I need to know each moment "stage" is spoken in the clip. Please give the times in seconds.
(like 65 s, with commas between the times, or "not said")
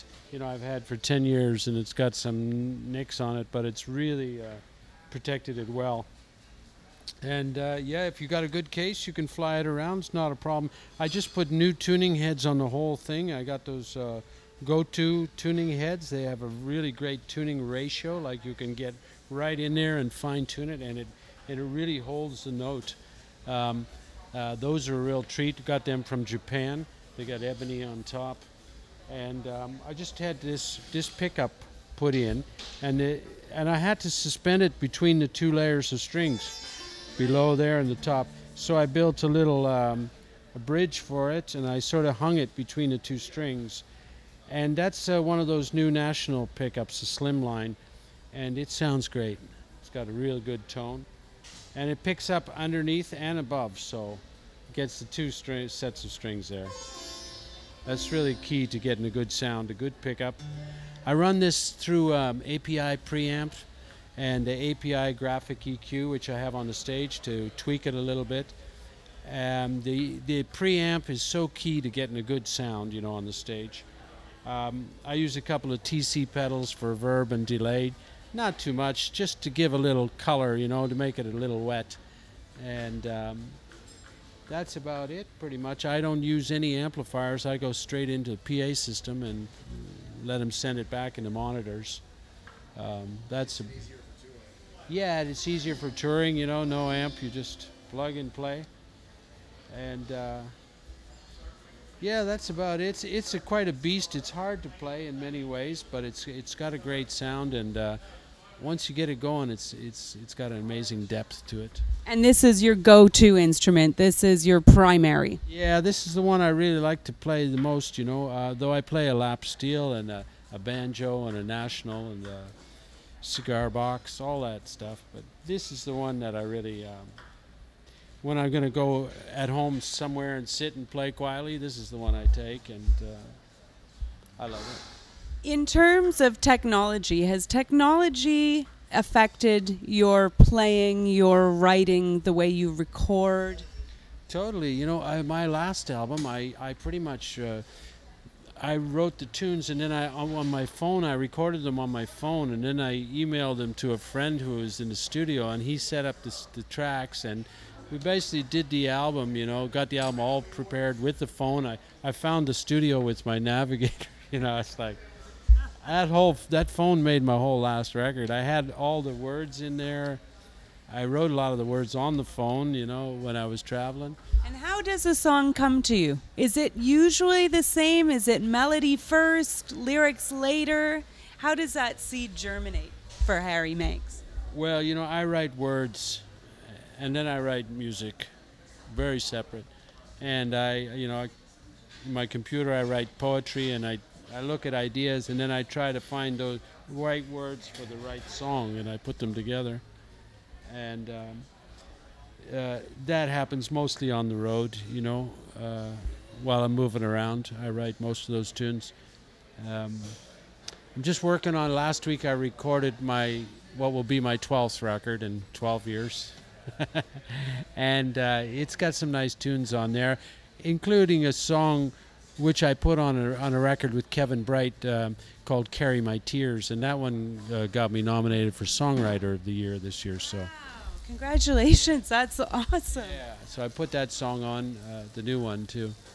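66 s, 73 s.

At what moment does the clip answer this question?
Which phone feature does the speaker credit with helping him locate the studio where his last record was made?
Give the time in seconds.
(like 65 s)
163 s.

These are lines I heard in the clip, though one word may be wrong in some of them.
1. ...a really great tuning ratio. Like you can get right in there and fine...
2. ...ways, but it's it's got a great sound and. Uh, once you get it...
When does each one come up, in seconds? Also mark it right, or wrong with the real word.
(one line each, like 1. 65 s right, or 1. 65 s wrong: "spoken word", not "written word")
1. 16 s right
2. 105 s right.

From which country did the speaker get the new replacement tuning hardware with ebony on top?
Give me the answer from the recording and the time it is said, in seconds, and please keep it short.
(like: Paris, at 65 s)
Japan, at 26 s.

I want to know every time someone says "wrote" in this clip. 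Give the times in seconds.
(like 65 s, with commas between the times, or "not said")
148 s, 171 s.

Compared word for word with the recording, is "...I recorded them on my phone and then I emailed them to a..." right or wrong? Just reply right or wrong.
right.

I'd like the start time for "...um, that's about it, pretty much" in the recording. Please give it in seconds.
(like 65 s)
83 s.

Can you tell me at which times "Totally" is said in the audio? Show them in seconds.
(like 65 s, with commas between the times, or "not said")
144 s.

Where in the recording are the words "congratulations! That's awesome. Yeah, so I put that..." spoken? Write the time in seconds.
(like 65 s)
231 s.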